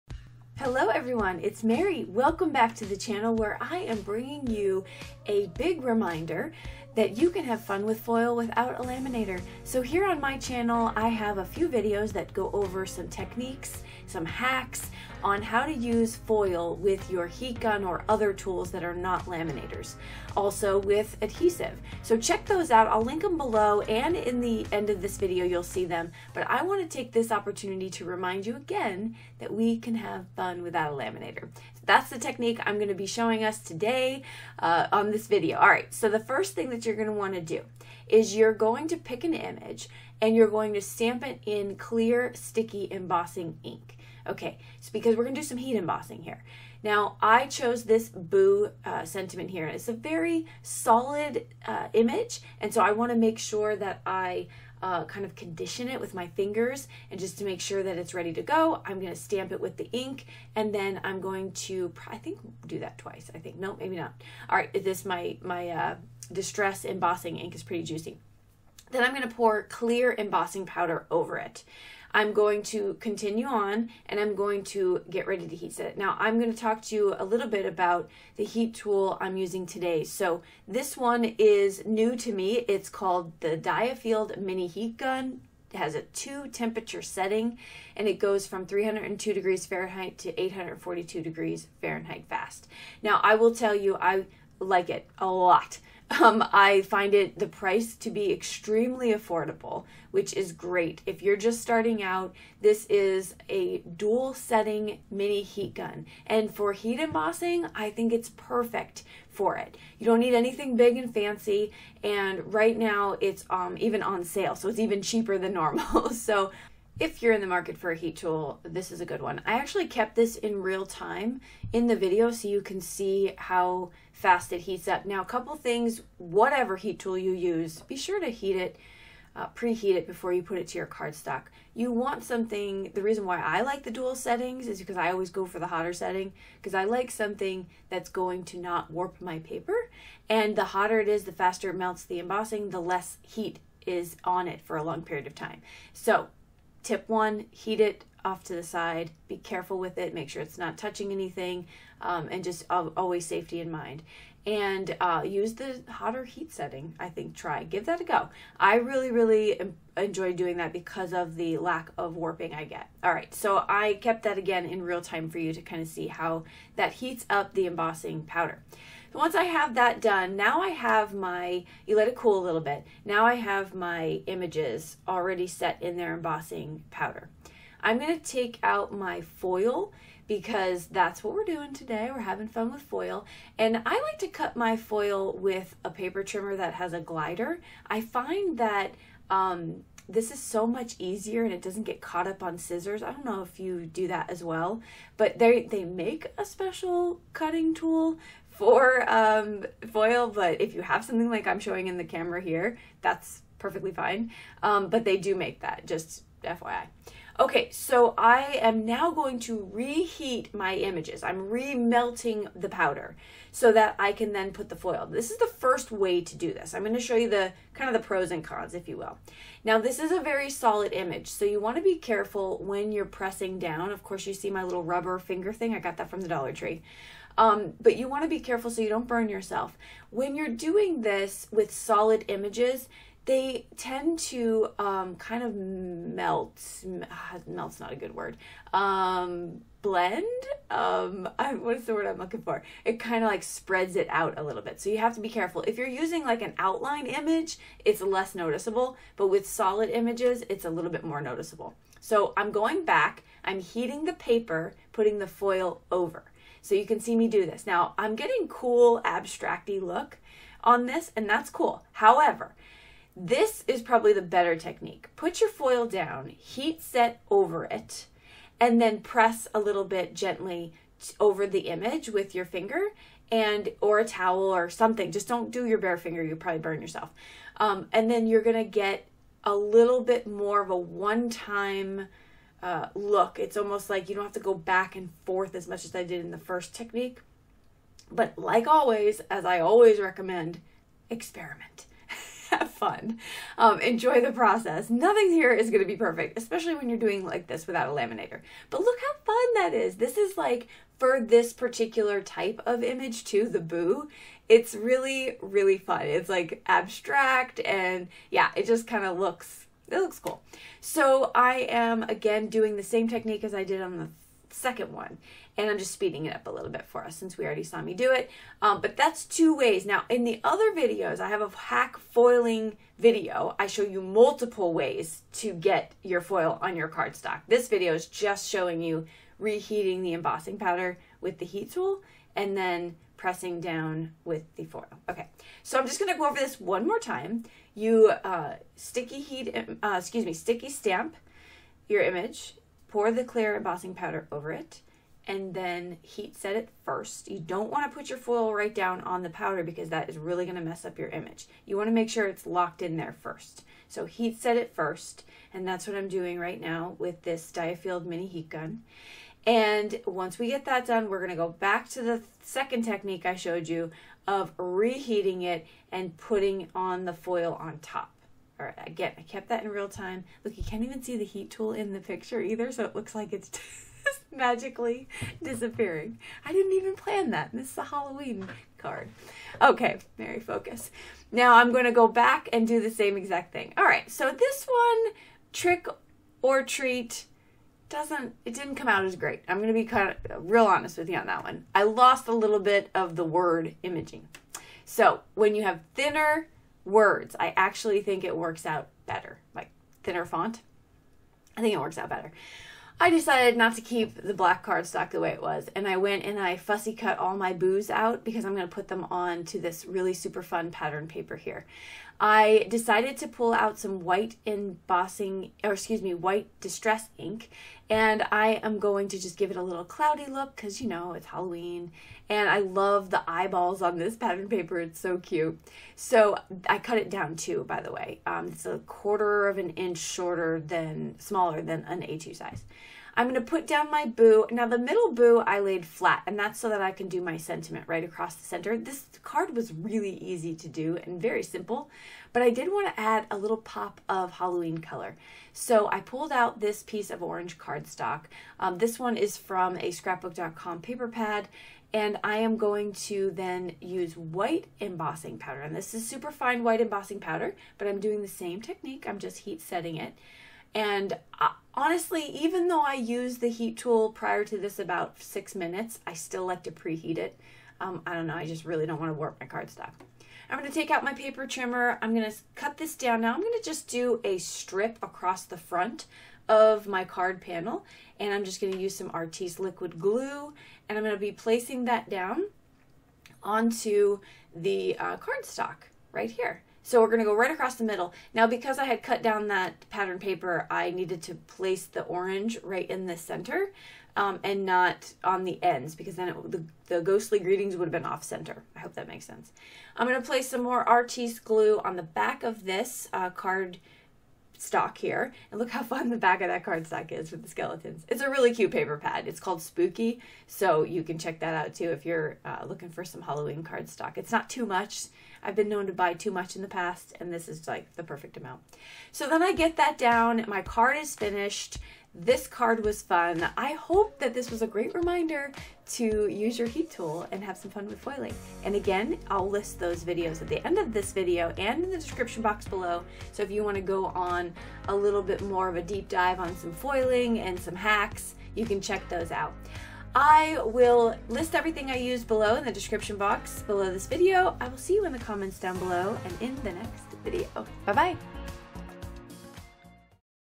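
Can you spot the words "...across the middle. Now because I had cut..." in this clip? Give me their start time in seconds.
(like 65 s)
487 s.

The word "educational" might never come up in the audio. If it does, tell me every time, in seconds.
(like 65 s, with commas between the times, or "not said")
not said.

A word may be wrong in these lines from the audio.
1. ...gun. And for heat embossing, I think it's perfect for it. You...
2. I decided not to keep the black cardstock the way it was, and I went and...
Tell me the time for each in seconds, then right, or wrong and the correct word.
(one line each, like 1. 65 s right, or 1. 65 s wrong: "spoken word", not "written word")
1. 105 s right
2. 402 s right.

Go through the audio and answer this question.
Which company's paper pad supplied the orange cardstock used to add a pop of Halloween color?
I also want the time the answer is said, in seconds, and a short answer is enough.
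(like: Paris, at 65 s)
scrapbook.com, at 449 s.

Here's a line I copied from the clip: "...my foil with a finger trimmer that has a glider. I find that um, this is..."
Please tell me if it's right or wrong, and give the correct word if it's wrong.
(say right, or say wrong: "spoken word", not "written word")
wrong: "paper", not "finger".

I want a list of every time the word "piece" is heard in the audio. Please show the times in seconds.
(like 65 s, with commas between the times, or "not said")
446 s.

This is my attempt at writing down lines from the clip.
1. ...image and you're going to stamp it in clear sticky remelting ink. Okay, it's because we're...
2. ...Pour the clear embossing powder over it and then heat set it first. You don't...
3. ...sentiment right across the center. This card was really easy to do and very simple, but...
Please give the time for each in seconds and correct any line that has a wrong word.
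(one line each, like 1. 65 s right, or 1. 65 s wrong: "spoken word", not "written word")
1. 39 s wrong: "embossing", not "remelting"
2. 342 s right
3. 437 s right.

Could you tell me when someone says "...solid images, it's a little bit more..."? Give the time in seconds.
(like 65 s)
249 s.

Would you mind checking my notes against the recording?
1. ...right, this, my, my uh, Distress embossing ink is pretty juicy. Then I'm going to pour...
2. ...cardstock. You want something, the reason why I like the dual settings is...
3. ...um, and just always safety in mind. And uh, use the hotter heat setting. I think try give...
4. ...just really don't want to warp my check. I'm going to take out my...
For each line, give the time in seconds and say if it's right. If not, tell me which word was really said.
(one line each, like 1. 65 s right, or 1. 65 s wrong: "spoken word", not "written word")
1. 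64 s right
2. 130 s right
3. 152 s right
4. 468 s wrong: "cardstock", not "check".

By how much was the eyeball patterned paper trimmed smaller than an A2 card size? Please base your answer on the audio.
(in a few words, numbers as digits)
a quarter of an inch.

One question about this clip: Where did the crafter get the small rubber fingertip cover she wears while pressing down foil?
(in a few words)
Dollar Tree.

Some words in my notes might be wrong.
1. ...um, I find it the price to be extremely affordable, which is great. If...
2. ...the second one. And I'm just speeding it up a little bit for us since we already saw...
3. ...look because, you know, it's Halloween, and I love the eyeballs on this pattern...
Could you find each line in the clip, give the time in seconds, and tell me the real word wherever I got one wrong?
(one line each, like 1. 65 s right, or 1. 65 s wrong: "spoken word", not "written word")
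1. 96 s right
2. 313 s right
3. 420 s right.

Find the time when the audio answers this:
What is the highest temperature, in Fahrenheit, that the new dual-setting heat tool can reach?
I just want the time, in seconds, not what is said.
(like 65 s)
90 s.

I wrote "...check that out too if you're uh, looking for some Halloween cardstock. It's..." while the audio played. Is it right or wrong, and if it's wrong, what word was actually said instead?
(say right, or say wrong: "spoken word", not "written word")
right.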